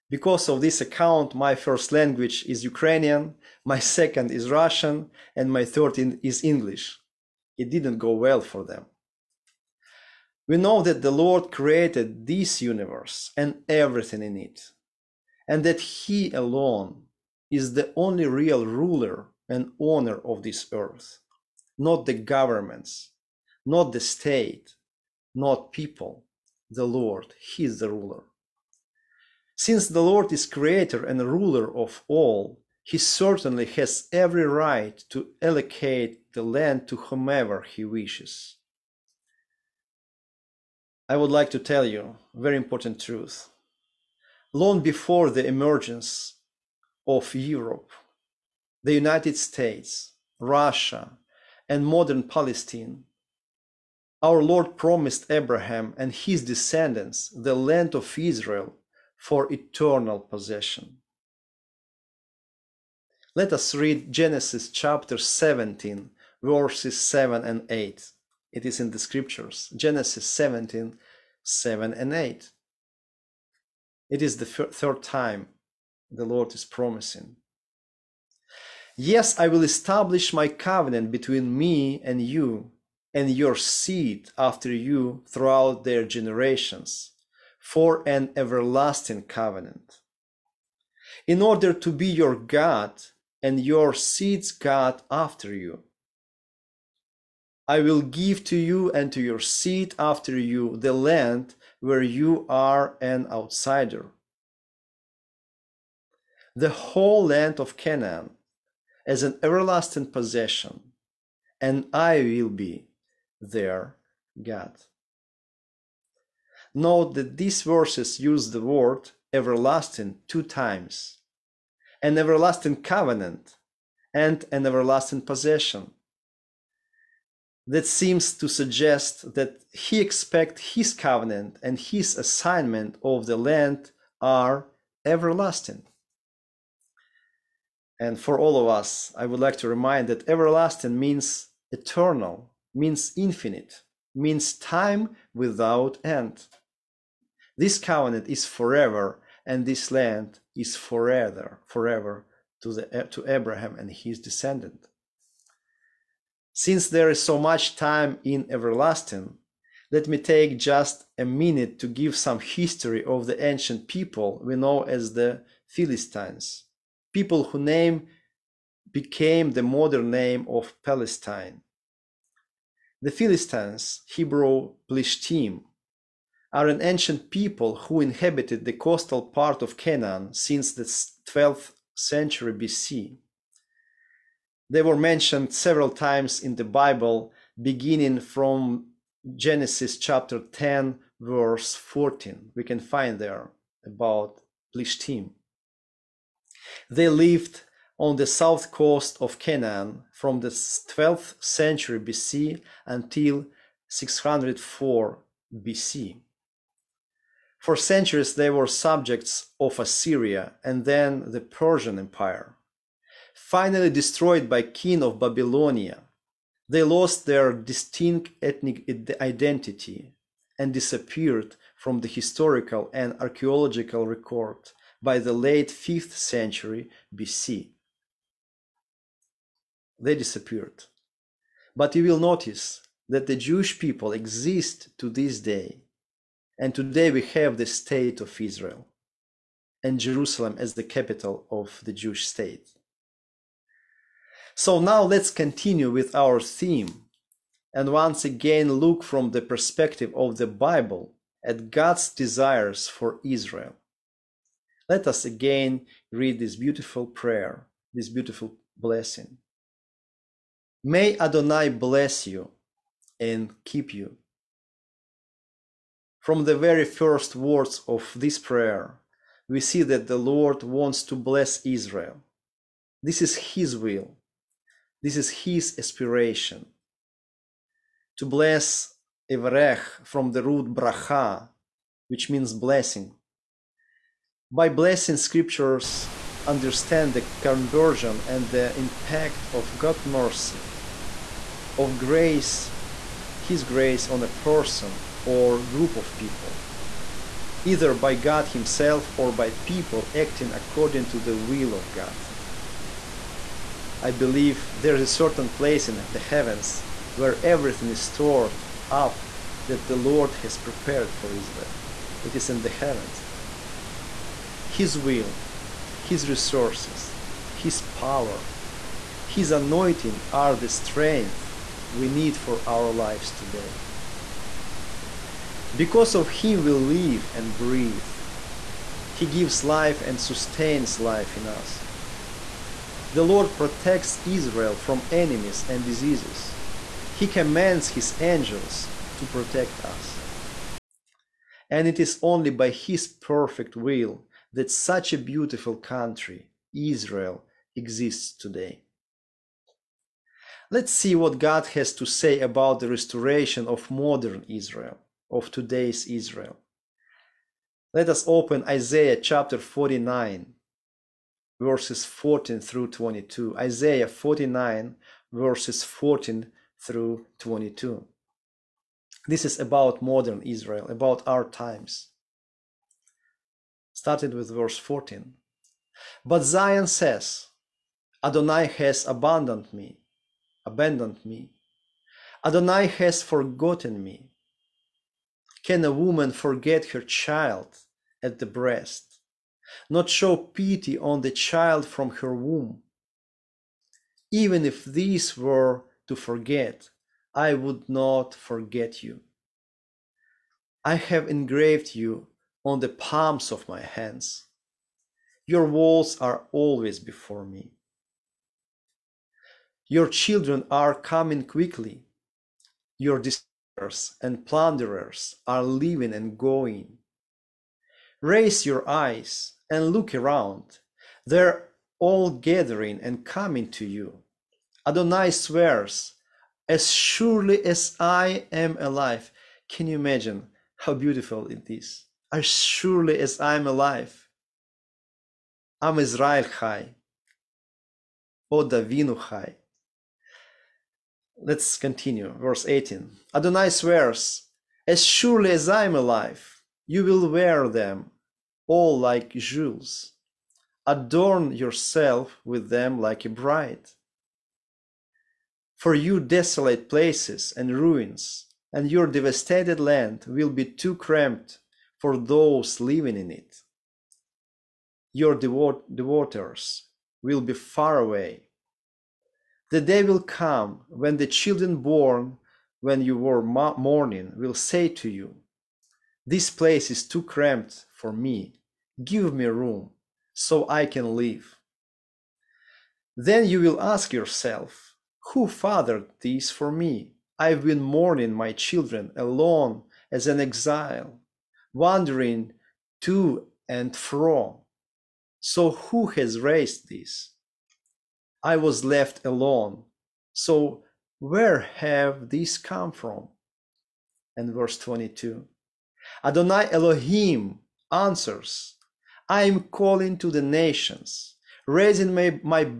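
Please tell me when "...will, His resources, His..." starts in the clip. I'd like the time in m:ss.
5:14.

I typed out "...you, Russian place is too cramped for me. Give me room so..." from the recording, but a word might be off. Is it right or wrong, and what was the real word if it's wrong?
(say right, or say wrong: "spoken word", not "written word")
wrong: "This", not "Russian".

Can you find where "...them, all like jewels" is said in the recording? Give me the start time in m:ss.
7:27.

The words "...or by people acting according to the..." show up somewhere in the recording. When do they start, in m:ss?
4:59.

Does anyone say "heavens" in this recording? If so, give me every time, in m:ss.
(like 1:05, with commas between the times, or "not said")
5:06, 5:12.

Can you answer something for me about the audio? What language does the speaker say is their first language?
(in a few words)
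Ukrainian.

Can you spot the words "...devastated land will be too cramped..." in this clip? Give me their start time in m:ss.
7:39.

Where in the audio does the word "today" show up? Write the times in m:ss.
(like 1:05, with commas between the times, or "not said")
3:56, 5:23, 5:48, 5:55.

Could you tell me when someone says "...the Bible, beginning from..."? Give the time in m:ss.
3:06.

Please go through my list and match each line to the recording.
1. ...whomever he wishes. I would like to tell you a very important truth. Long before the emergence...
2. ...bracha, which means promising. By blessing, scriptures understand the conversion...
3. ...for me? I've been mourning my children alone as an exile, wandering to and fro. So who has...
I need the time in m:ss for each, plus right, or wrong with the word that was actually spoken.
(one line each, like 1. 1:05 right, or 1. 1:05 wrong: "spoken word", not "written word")
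1. 0:36 right
2. 4:40 wrong: "blessing", not "promising"
3. 8:06 right.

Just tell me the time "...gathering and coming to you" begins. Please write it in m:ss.
7:02.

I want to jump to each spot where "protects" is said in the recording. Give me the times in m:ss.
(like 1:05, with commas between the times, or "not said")
5:33, 5:39.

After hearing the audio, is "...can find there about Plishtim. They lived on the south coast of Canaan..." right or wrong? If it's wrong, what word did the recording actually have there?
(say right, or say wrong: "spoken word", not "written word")
right.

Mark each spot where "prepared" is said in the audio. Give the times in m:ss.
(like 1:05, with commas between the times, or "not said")
5:10.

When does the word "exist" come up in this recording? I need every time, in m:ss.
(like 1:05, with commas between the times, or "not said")
3:54, 5:47.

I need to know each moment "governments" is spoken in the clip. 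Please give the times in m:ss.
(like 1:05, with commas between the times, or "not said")
0:22.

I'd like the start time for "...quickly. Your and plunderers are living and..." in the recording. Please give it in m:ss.
6:51.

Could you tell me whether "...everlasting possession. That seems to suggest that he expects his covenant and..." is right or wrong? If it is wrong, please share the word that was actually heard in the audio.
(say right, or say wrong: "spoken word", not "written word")
right.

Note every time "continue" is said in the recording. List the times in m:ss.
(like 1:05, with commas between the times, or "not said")
4:05, 7:21.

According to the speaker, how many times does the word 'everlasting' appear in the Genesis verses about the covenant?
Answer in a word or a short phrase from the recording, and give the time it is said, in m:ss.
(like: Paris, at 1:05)
2, at 2:00.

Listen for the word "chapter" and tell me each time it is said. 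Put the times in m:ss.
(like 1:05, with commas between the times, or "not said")
1:04, 3:09, 5:59.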